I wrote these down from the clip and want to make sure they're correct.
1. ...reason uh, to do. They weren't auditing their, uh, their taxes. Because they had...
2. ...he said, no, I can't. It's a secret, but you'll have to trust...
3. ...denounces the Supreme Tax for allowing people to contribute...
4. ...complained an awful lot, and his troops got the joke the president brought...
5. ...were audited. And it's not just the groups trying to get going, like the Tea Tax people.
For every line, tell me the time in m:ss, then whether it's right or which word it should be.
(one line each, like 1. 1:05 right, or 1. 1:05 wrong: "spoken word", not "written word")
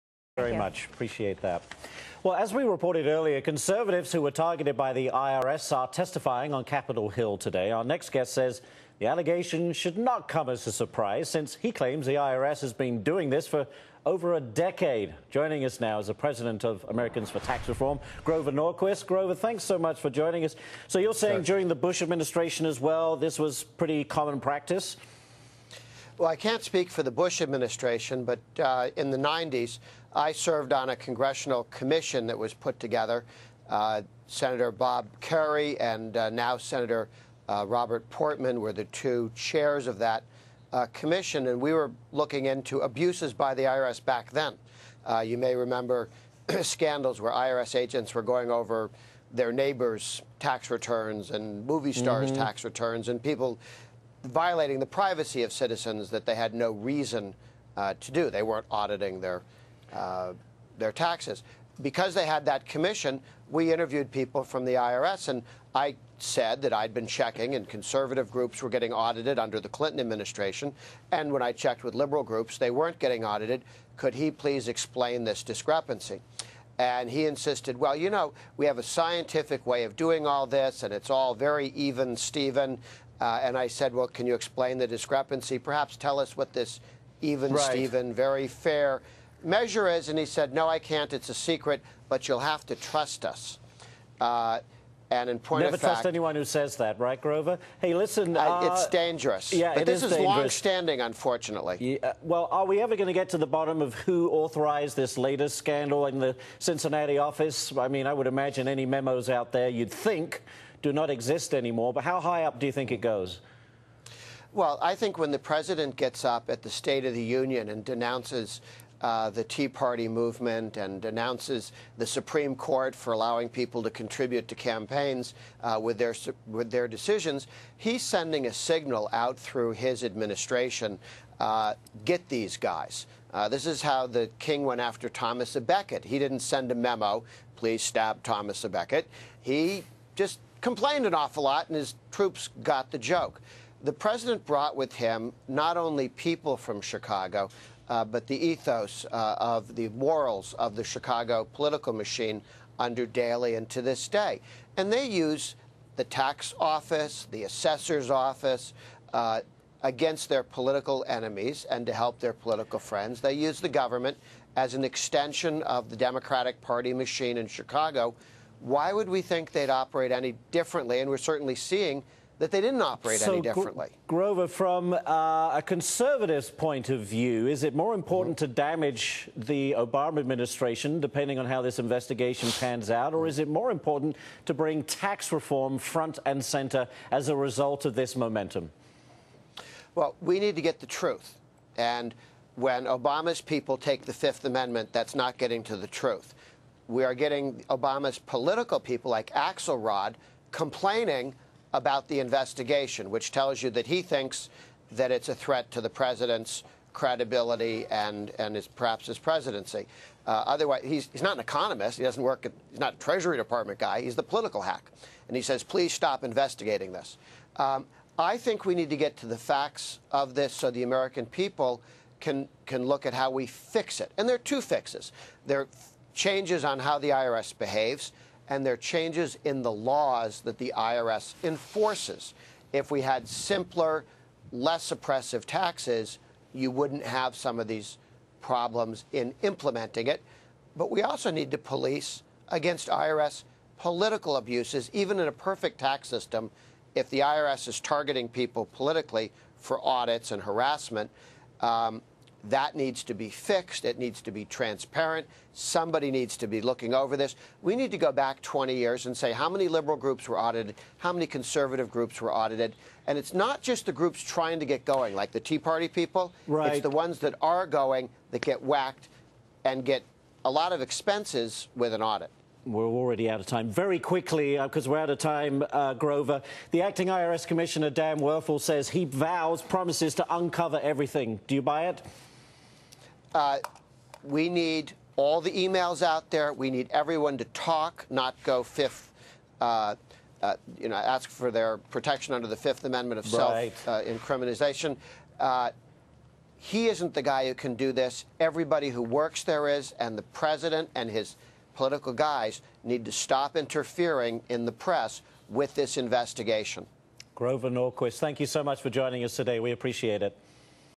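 1. 0:56 right
2. 1:30 right
3. 2:01 wrong: "Court", not "Tax"
4. 2:20 right
5. 4:22 wrong: "Party", not "Tax".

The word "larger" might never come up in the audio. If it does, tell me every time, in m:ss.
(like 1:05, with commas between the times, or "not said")
not said.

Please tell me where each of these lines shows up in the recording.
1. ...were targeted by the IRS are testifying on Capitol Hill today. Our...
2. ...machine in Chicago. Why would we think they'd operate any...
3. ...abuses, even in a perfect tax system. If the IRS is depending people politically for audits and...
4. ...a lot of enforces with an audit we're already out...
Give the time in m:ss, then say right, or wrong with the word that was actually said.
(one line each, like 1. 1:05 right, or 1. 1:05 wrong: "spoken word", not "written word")
1. 0:04 right
2. 2:46 right
3. 4:04 wrong: "targeting", not "depending"
4. 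4:30 wrong: "expenses", not "enforces".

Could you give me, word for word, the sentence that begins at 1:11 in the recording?
And when I checked with liberal groups, they weren't getting audited.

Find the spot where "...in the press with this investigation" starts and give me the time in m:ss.
5:04.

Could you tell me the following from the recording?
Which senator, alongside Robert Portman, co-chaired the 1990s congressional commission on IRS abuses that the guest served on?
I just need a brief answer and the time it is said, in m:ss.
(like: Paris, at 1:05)
Bob Kerry, at 0:34.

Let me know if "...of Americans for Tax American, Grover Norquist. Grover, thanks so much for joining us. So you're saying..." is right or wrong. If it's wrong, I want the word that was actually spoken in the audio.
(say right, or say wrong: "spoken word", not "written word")
wrong: "Reform", not "American".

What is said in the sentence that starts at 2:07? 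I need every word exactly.
He's sending a signal out through his administration: uh, get these guys.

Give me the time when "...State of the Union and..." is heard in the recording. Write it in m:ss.
1:56.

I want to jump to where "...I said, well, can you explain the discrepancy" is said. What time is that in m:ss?
1:23.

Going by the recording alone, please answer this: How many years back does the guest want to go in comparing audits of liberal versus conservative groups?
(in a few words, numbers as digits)
20.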